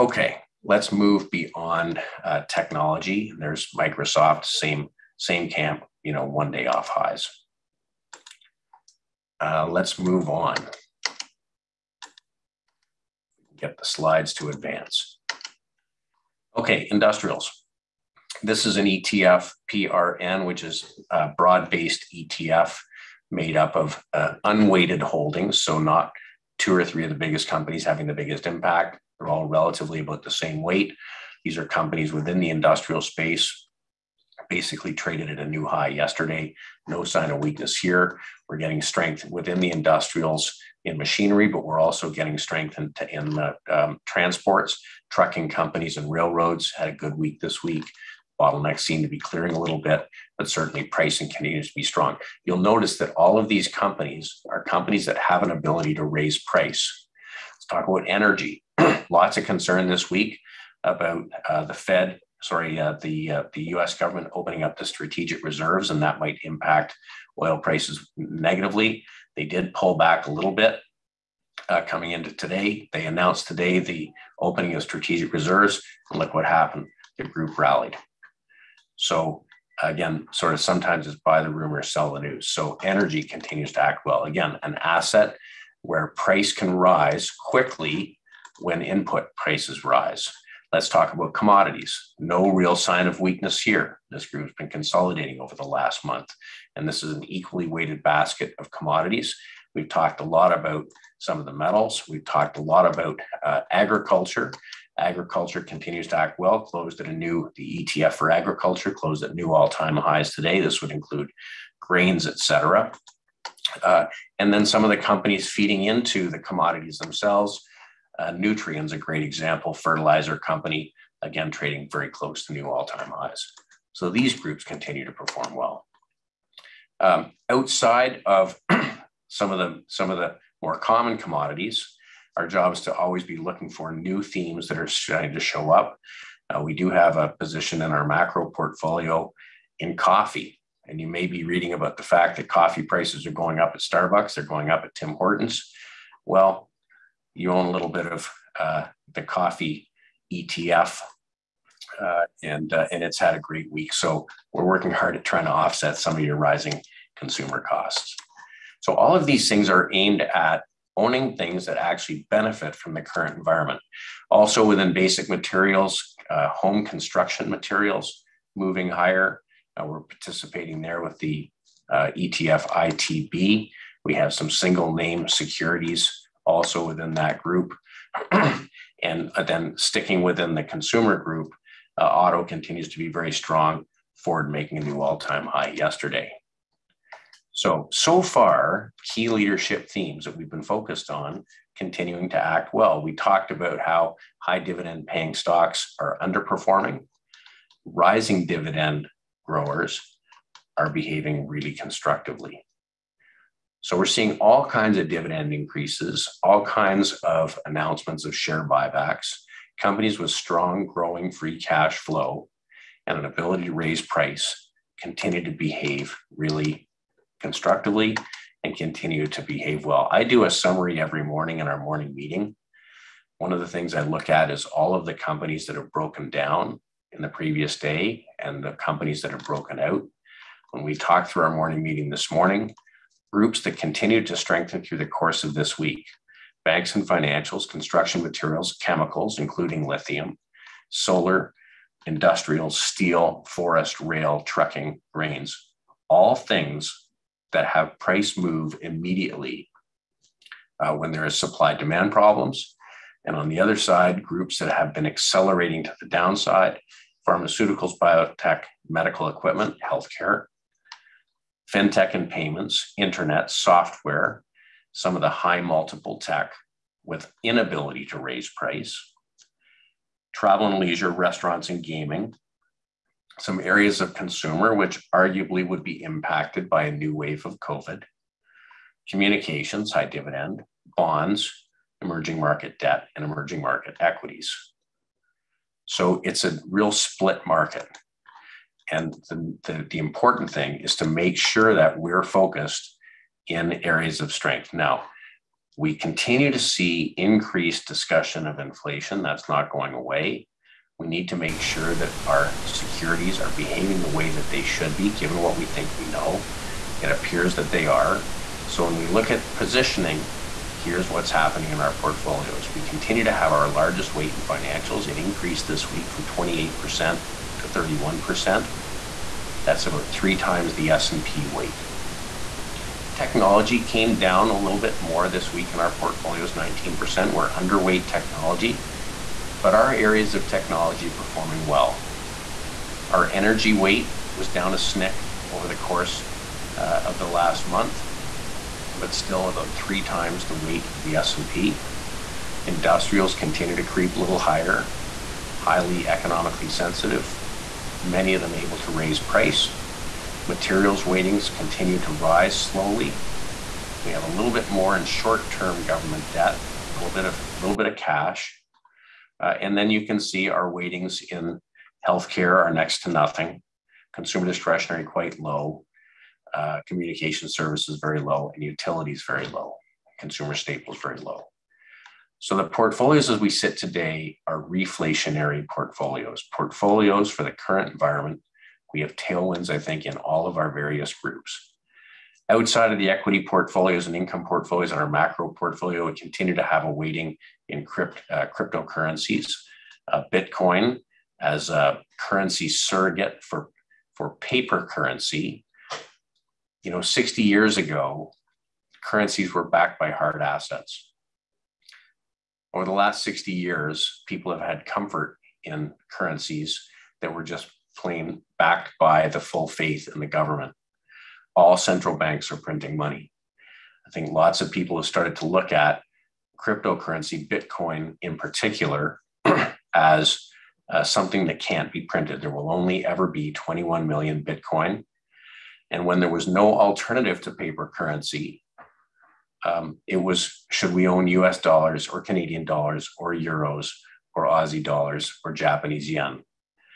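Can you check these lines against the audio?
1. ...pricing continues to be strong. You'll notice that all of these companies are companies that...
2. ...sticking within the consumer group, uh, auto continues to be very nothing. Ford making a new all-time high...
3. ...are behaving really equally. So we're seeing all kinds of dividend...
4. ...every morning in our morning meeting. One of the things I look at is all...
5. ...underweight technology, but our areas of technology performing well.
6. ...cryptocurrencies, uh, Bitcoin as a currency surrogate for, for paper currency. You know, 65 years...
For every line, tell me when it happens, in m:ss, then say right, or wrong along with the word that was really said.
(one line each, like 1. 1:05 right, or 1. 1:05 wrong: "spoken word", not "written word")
1. 0:50 right
2. 2:59 wrong: "strong", not "nothing"
3. 3:20 wrong: "constructively", not "equally"
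4. 3:41 right
5. 5:27 right
6. 6:28 wrong: "60", not "65".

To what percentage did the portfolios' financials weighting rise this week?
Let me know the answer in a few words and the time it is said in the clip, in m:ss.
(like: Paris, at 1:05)
31%, at 5:17.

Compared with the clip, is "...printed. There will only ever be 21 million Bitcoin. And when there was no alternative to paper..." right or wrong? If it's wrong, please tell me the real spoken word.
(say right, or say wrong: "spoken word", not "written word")
right.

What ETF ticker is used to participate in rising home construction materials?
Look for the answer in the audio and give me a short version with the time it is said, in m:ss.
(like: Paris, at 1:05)
ITB, at 2:52.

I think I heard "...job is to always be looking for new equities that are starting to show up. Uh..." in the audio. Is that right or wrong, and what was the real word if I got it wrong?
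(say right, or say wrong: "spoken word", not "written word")
wrong: "themes", not "equities".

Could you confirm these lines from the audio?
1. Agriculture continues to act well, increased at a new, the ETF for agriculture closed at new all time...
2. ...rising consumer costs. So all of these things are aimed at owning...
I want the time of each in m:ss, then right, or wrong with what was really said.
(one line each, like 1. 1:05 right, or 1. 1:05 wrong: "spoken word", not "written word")
1. 1:44 wrong: "closed", not "increased"
2. 2:36 right.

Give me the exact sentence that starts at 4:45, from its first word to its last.
So it's a real split market.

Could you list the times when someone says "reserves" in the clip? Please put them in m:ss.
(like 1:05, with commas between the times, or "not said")
1:05, 1:15.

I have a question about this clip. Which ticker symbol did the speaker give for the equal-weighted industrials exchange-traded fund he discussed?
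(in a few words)
PRN.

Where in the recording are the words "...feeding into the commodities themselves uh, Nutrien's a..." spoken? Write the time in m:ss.
1:55.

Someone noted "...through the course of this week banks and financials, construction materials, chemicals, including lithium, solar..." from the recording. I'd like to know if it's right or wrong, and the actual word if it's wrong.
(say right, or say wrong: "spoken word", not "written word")
right.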